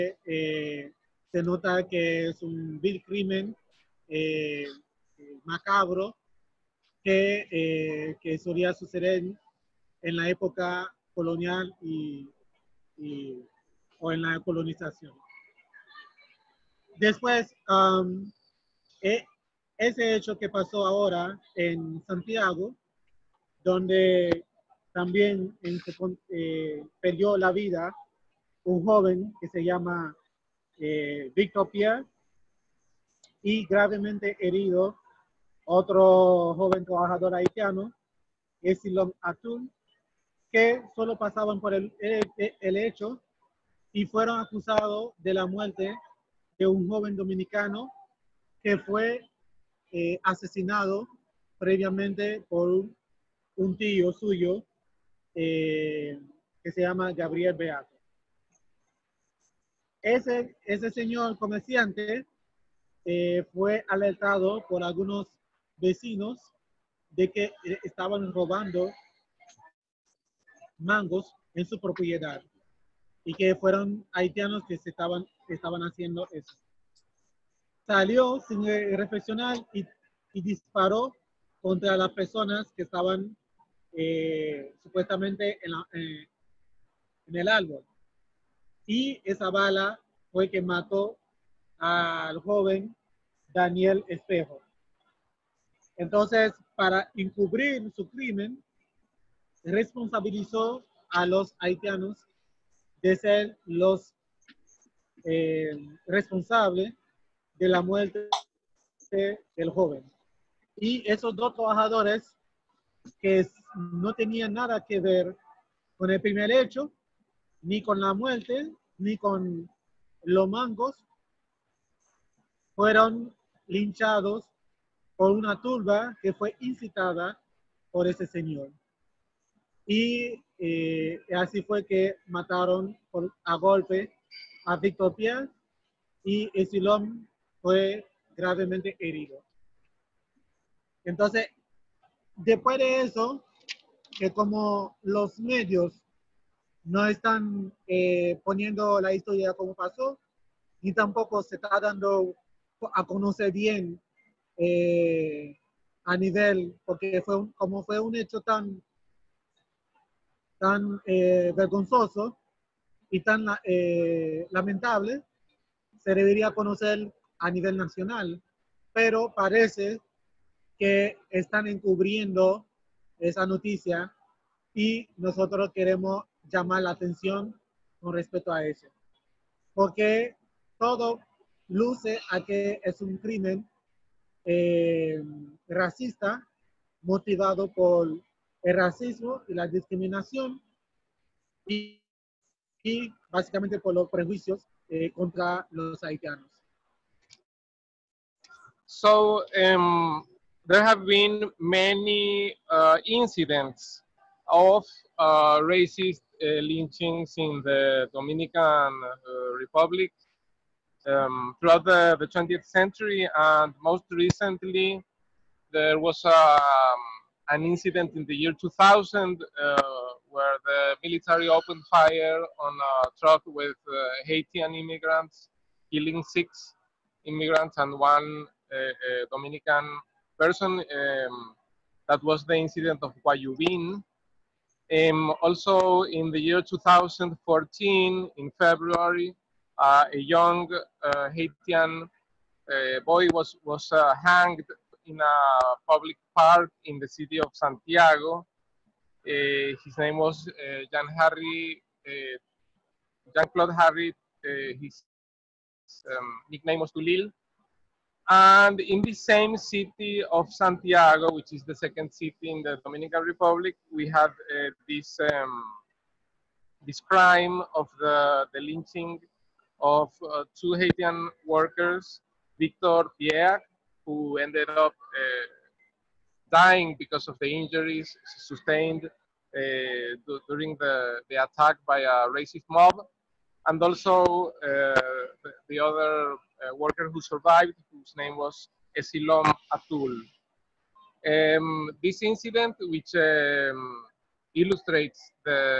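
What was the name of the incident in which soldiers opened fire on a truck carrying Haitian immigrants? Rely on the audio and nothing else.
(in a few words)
Guayubin.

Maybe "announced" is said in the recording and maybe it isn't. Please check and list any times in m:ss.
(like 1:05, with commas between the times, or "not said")
not said.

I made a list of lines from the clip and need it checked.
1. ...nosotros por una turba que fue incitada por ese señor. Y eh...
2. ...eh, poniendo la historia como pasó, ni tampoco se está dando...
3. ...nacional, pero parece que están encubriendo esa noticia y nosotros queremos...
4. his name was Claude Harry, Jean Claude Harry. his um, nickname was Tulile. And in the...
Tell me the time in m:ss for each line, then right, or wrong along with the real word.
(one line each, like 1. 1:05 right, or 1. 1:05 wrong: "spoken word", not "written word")
1. 2:03 wrong: "linchados", not "nosotros"
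2. 2:27 right
3. 2:47 right
4. 4:09 wrong: "Jean", not "Claude".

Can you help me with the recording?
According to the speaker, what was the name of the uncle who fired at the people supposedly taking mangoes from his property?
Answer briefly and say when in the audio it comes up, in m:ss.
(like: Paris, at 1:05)
Gabriel Beato, at 0:57.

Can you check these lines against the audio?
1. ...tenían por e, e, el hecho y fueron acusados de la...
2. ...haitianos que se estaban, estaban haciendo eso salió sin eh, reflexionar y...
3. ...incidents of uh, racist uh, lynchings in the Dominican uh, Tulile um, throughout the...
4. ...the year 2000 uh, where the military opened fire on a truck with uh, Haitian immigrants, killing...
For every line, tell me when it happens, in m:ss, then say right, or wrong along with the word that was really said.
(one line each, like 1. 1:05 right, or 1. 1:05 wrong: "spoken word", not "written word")
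1. 0:41 wrong: "pasaban", not "tenían"
2. 1:14 right
3. 3:23 wrong: "Republic", not "Tulile"
4. 3:38 right.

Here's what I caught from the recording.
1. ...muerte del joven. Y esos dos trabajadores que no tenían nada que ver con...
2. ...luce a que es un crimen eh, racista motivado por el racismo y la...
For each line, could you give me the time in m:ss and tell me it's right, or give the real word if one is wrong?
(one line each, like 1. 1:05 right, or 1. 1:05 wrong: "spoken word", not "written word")
1. 1:47 right
2. 3:01 right.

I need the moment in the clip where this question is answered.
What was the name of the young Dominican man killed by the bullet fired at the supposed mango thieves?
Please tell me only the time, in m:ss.
1:33.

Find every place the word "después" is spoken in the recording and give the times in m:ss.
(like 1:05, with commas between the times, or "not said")
0:16, 2:22.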